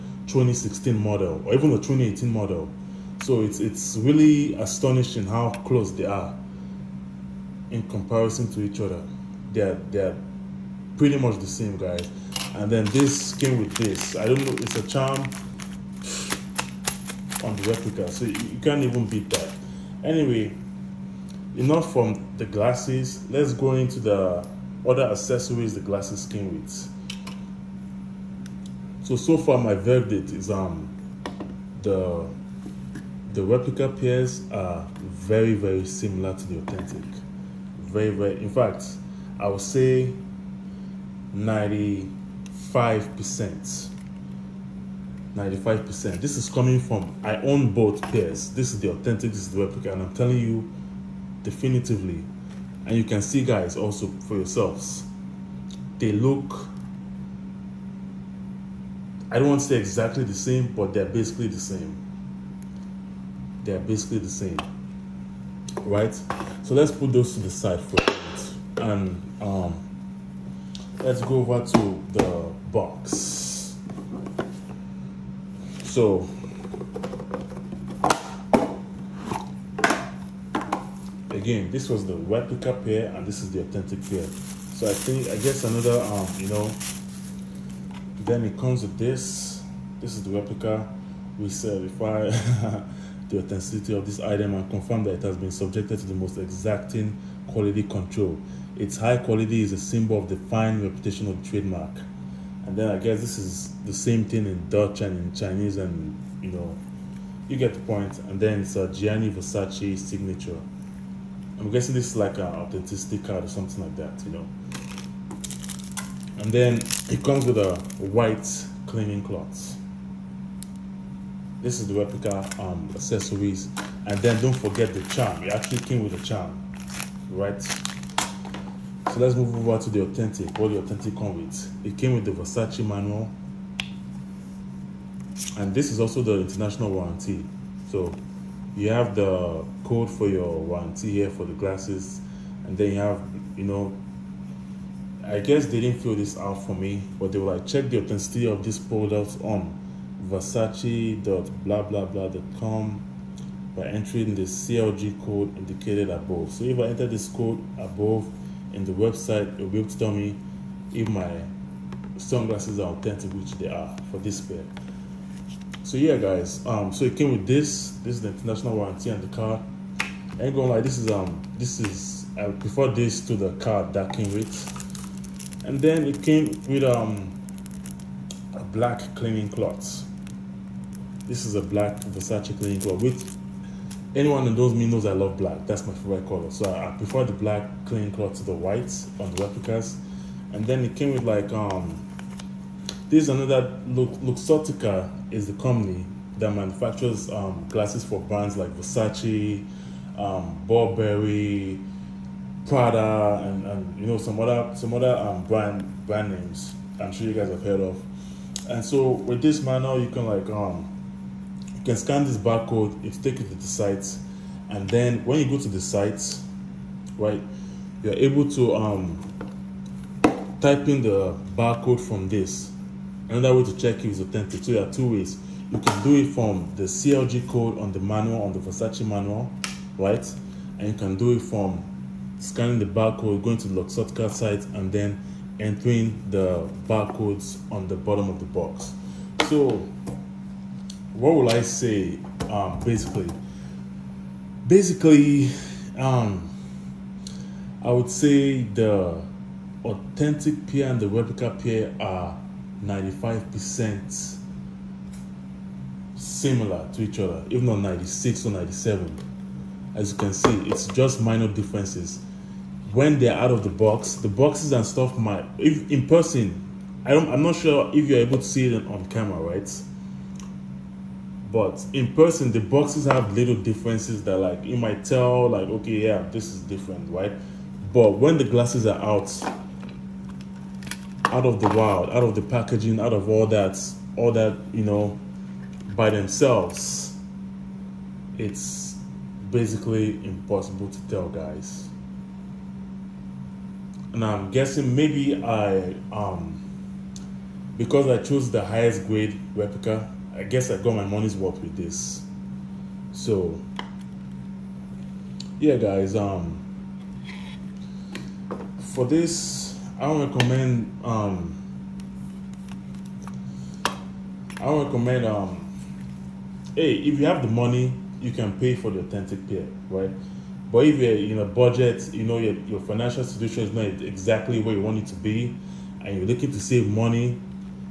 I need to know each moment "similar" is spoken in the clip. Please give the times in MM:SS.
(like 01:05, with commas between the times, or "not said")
00:35, 04:16.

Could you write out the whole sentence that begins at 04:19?
As you can see, it's just minor differences.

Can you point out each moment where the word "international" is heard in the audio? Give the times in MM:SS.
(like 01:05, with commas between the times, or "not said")
02:16, 02:48.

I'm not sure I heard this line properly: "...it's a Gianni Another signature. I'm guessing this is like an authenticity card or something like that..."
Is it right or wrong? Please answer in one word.
wrong.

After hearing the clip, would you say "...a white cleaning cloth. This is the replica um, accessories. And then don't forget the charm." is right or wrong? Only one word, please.
right.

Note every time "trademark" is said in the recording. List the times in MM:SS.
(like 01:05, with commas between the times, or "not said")
01:41.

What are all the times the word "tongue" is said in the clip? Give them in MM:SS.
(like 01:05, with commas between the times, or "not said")
not said.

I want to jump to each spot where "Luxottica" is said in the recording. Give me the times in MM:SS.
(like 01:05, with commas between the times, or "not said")
03:14, 03:53.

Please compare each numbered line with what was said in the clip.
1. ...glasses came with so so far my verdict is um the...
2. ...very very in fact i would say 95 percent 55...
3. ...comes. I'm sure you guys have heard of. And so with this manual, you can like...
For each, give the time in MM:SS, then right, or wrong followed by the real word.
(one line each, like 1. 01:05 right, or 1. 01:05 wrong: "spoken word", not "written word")
1. 00:25 right
2. 00:37 wrong: "95", not "55"
3. 03:26 wrong: "names", not "comes".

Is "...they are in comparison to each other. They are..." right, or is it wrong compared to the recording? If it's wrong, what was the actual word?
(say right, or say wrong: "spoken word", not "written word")
right.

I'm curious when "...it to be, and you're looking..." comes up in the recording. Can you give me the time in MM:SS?
05:24.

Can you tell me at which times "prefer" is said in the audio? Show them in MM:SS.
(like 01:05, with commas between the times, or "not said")
02:52, 03:06.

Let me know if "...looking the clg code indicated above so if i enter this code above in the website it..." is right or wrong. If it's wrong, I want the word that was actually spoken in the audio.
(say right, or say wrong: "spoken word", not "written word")
wrong: "entering", not "looking".